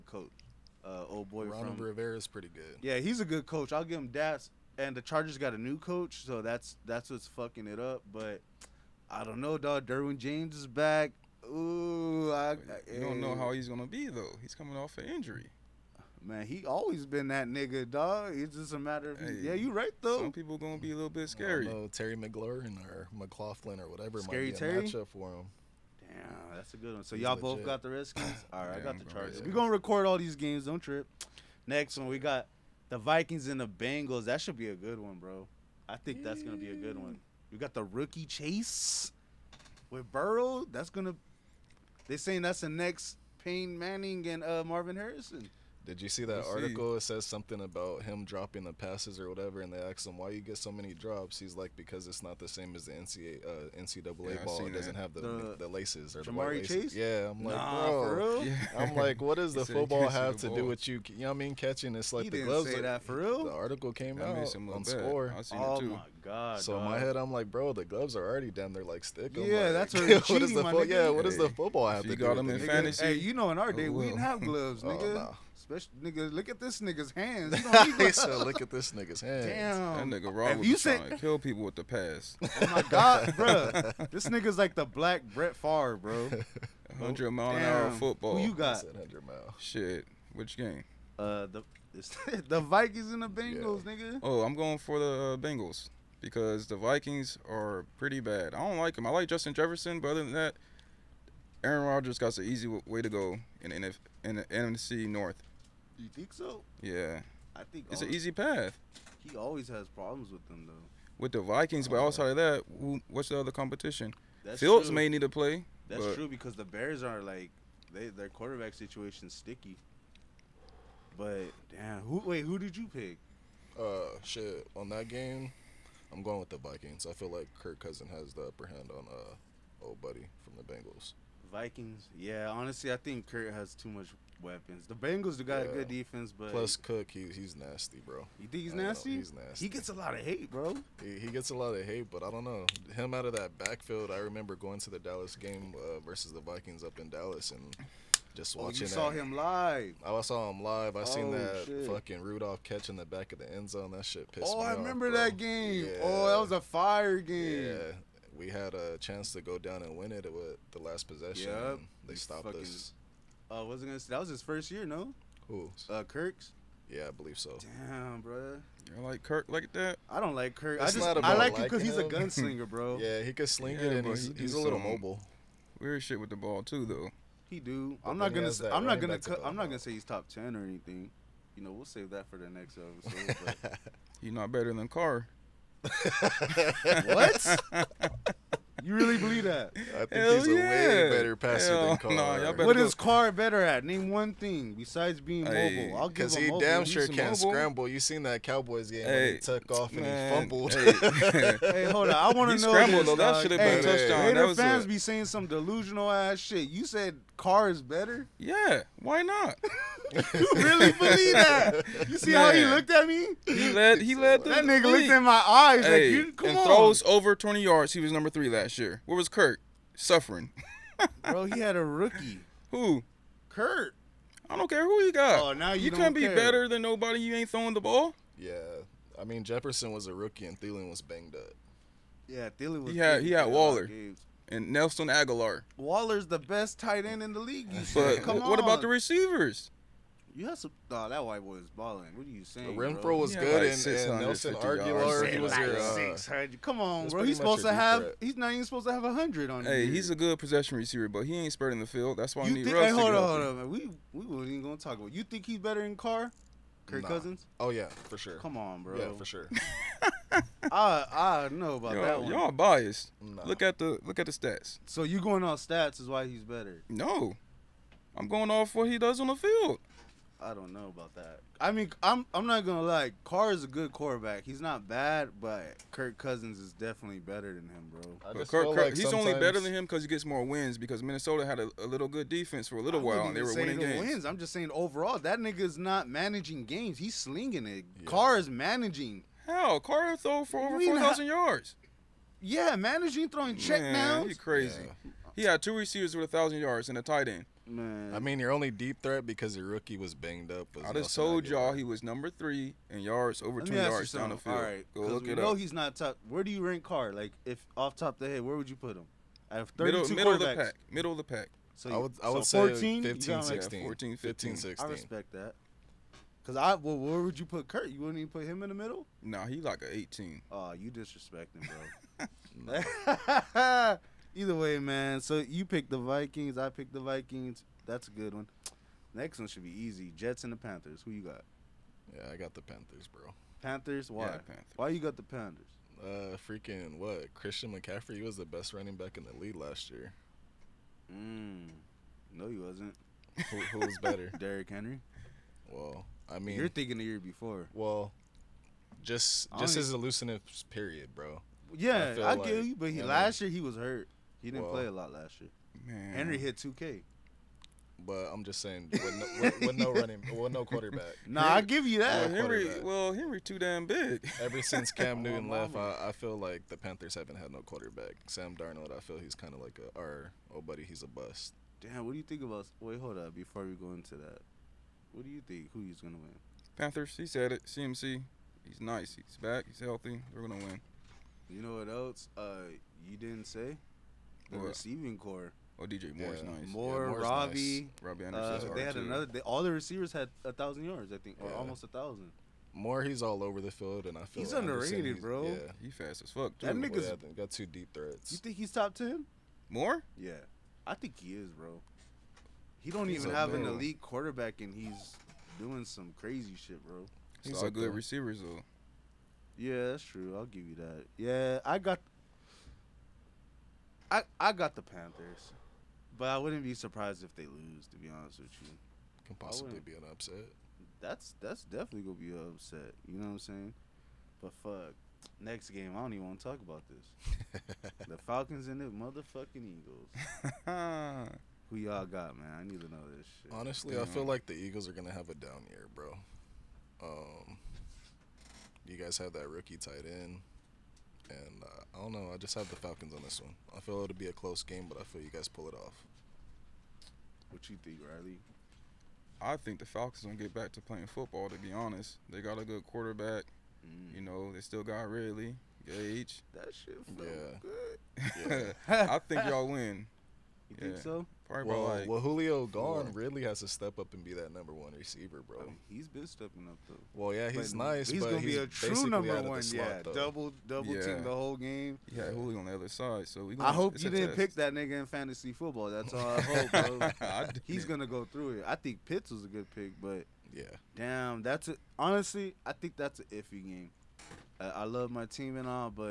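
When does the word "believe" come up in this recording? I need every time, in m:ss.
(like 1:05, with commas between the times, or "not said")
2:47, 3:09, 3:30.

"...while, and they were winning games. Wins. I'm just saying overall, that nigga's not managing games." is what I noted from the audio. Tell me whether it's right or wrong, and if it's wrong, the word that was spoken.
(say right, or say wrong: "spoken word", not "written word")
right.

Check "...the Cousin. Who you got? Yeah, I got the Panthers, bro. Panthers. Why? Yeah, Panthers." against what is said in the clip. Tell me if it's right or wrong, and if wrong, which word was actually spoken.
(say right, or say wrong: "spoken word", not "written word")
wrong: "Panthers", not "Cousin".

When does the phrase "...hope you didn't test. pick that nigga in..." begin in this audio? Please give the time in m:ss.
7:53.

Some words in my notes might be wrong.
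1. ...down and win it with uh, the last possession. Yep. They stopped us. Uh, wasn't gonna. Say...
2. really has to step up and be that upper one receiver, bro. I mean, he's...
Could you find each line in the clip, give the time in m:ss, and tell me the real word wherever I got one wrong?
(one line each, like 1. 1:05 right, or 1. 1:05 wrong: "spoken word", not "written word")
1. 2:39 right
2. 7:43 wrong: "number", not "upper".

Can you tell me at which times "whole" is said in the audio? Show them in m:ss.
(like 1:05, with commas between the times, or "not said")
7:51.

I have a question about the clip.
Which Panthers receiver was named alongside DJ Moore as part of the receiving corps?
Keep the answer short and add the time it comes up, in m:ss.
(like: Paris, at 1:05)
Robbie Anderson, at 6:28.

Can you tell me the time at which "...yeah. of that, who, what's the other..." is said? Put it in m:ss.
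1:52.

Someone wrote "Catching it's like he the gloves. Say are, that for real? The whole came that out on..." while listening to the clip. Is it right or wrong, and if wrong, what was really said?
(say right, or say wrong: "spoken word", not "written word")
wrong: "article", not "whole".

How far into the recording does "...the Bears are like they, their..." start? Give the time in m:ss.
1:56.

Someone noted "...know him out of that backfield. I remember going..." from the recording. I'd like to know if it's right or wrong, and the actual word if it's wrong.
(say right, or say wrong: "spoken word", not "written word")
right.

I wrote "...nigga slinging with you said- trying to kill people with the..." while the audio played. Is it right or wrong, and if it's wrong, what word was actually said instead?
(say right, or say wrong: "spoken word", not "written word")
wrong: "wrong", not "slinging".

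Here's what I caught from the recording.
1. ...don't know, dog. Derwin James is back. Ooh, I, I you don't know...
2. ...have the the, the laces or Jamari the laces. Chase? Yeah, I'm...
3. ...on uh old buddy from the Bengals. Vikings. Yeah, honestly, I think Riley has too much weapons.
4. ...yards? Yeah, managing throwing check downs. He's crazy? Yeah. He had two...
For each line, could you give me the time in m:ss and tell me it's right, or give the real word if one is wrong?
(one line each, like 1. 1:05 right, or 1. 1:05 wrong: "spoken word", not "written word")
1. 0:09 right
2. 0:54 right
3. 2:08 wrong: "Kurt", not "Riley"
4. 4:51 right.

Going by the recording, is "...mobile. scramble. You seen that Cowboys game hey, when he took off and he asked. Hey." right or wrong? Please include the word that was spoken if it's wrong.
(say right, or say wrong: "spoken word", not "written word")
wrong: "fumbled", not "asked".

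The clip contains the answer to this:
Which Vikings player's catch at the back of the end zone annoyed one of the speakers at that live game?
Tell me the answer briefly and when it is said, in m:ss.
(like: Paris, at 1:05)
Rudolph, at 2:32.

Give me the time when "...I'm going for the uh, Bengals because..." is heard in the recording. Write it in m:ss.
1:34.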